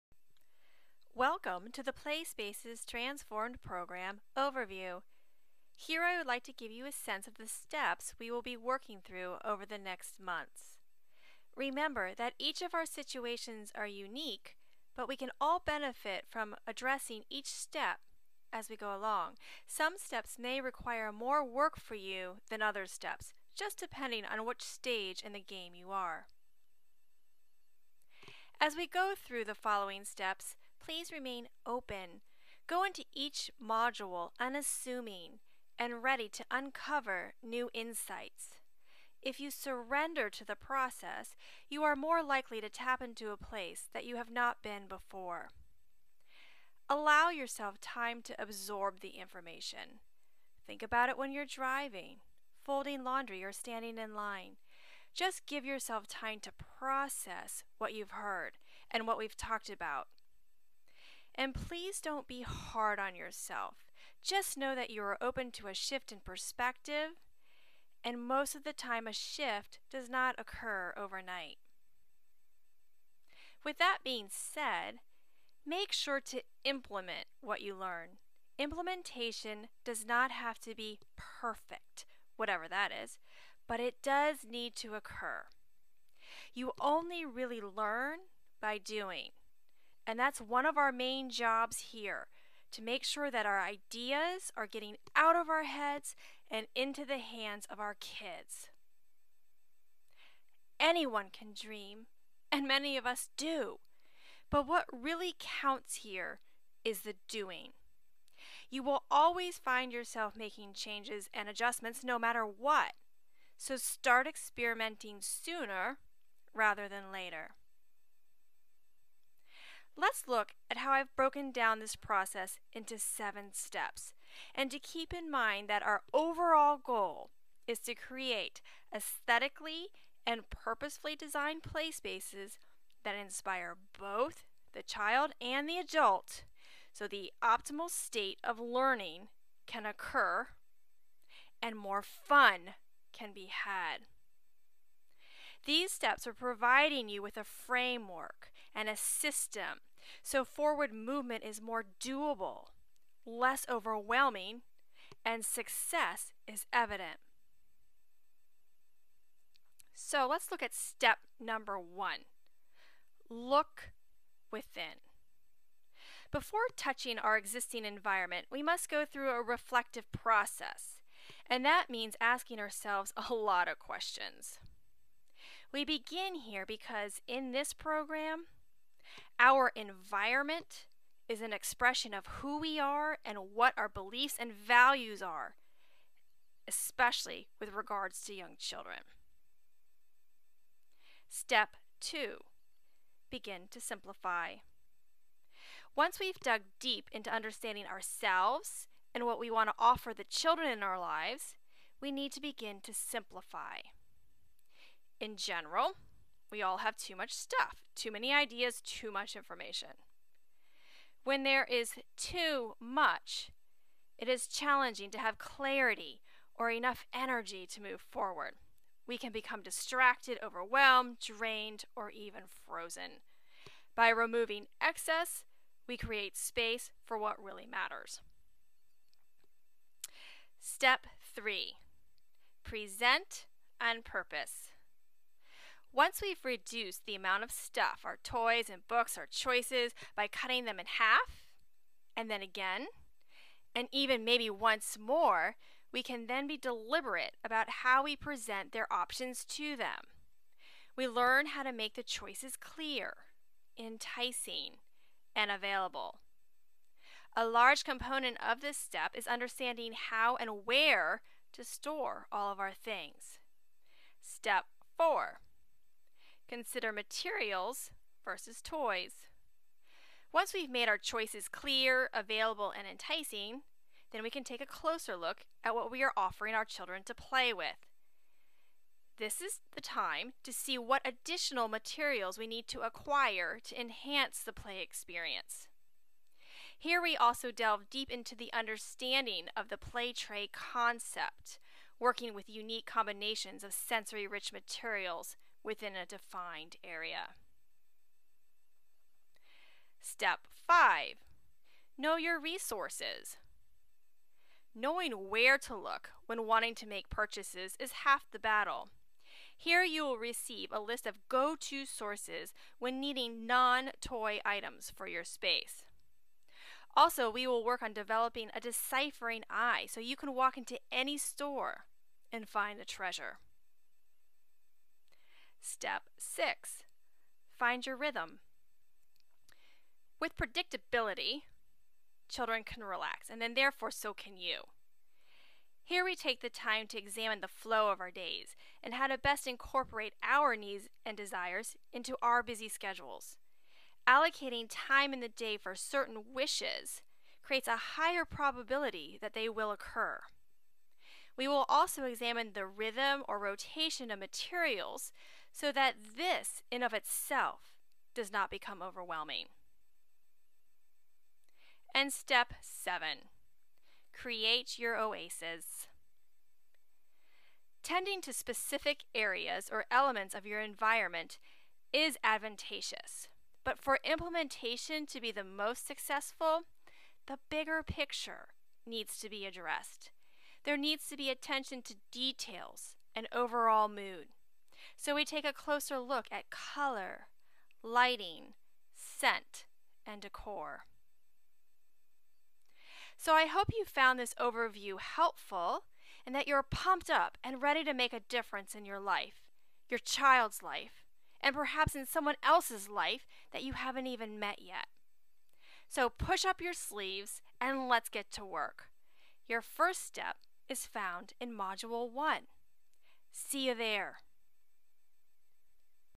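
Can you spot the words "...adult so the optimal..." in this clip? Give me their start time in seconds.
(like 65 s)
135 s.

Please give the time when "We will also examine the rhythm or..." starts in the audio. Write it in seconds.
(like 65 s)
351 s.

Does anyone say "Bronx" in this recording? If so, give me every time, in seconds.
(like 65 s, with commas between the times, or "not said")
not said.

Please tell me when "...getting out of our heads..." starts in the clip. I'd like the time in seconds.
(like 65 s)
94 s.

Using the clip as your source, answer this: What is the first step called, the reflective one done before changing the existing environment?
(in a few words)
Look within.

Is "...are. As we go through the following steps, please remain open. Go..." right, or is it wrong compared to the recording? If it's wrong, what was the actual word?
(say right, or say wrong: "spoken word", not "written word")
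right.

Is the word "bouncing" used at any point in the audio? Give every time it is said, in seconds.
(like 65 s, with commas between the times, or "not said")
not said.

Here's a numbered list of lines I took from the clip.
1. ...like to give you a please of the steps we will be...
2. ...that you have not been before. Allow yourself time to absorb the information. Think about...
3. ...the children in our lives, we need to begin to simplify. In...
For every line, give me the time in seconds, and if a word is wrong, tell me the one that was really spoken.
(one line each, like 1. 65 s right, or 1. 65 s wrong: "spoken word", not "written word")
1. 6 s wrong: "sense", not "please"
2. 43 s right
3. 200 s right.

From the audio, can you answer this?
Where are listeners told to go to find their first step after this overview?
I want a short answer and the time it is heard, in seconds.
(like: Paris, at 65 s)
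Module 1, at 411 s.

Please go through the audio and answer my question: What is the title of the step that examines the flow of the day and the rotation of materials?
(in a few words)
Find your rhythm.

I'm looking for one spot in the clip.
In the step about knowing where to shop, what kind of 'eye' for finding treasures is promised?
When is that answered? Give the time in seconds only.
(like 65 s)
318 s.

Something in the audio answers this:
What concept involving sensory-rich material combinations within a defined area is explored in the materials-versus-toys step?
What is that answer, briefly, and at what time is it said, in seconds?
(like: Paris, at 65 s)
Play tray, at 289 s.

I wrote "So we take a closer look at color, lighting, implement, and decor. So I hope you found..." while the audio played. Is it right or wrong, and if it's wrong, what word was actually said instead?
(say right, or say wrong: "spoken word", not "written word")
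wrong: "scent", not "implement".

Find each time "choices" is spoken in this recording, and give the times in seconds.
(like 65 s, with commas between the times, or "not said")
239 s, 252 s, 270 s.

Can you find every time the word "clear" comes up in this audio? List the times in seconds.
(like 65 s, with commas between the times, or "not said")
252 s, 271 s.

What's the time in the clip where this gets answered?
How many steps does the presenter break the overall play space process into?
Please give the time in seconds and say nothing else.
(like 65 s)
122 s.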